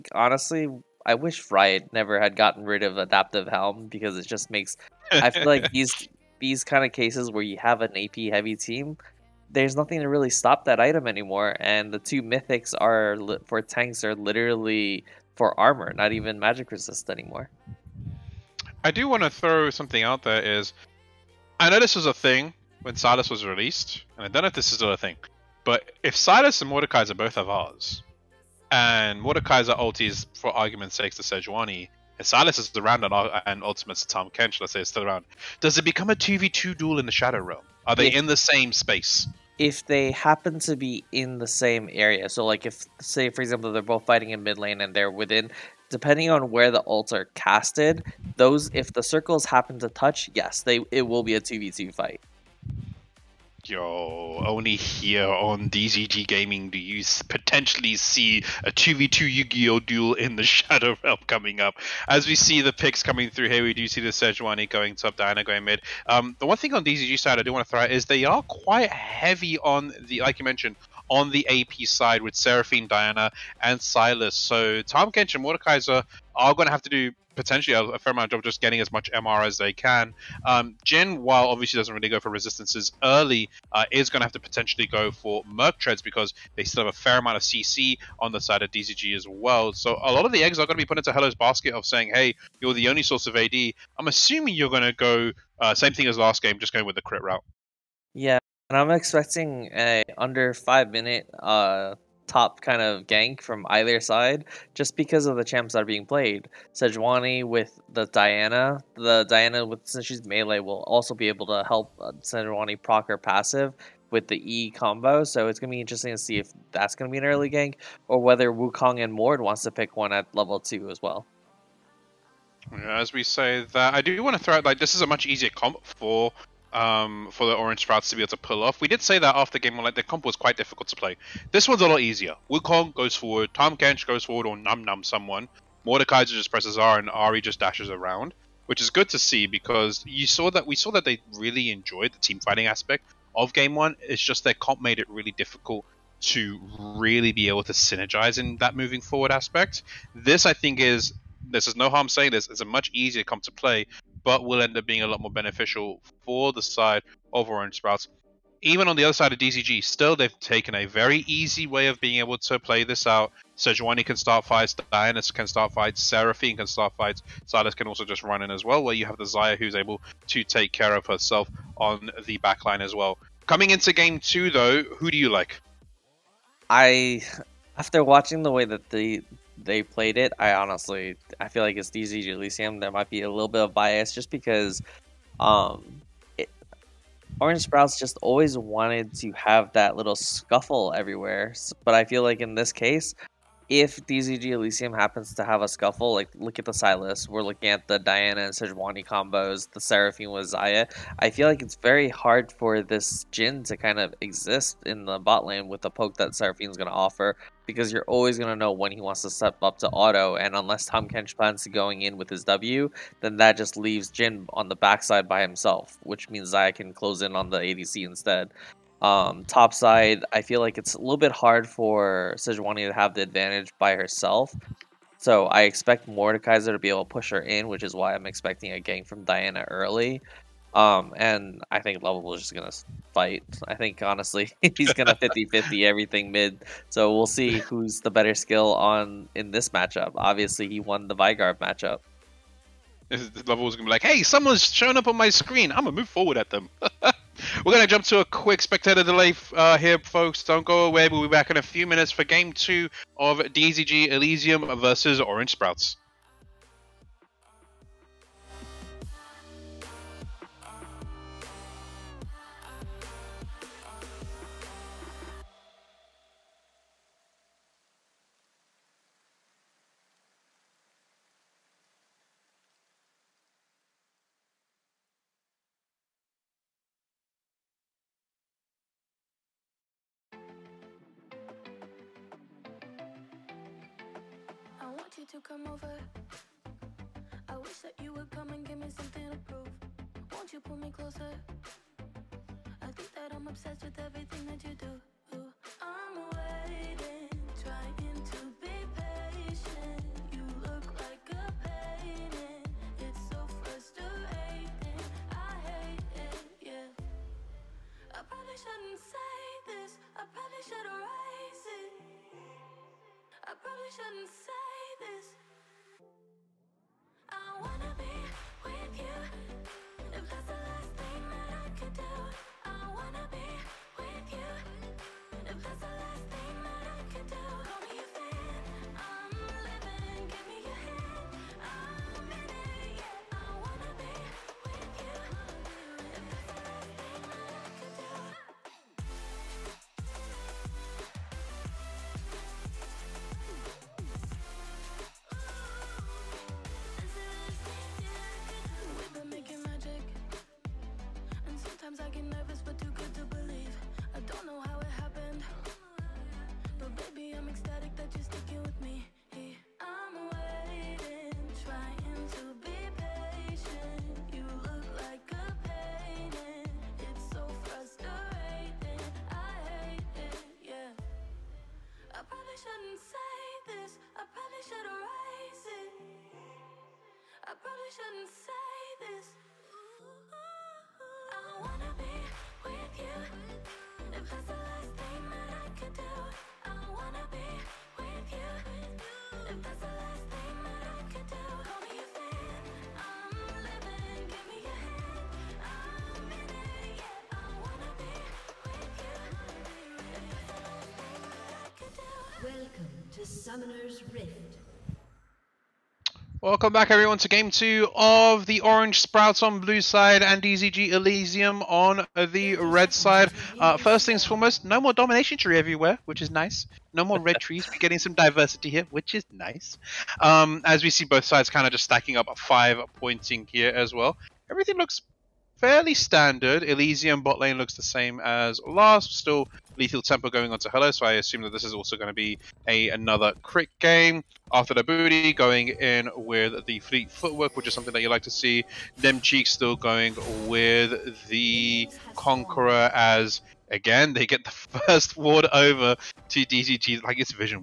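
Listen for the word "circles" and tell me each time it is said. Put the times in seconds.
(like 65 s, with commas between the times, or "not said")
49 s.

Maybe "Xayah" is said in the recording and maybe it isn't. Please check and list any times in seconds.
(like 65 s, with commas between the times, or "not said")
169 s, 200 s, 216 s.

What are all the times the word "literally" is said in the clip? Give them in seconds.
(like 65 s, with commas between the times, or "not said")
14 s.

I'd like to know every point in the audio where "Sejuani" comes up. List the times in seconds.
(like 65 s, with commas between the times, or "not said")
31 s, 64 s, 106 s, 112 s, 163 s, 198 s, 222 s.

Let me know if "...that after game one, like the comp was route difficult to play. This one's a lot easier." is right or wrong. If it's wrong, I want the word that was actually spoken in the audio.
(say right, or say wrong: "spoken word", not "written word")
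wrong: "quite", not "route".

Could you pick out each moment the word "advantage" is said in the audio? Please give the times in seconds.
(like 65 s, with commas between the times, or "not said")
223 s.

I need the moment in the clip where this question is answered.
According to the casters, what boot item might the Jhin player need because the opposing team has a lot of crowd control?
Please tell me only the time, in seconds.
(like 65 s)
85 s.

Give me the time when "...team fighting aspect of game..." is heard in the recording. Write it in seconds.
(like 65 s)
142 s.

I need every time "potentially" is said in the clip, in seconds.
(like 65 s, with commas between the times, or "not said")
57 s, 77 s, 84 s.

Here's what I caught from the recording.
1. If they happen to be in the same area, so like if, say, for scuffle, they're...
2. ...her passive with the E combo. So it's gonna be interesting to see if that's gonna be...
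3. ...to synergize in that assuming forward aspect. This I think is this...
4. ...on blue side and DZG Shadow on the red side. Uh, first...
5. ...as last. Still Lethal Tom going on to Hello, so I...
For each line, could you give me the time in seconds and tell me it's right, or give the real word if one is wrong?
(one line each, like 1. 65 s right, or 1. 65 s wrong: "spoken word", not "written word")
1. 39 s wrong: "example", not "scuffle"
2. 113 s right
3. 147 s wrong: "moving", not "assuming"
4. 409 s wrong: "Elysium", not "Shadow"
5. 428 s wrong: "Tempo", not "Tom".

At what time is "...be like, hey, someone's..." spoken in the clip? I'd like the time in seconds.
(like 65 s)
243 s.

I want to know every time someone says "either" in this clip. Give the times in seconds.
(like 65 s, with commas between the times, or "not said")
103 s.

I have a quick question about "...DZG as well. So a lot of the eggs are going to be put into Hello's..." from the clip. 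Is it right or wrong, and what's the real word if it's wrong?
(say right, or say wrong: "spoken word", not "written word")
right.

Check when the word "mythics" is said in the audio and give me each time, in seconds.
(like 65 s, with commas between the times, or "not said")
12 s.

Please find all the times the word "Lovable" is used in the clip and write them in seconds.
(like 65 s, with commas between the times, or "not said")
232 s, 243 s.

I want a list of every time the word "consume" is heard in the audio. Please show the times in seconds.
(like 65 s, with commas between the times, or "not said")
not said.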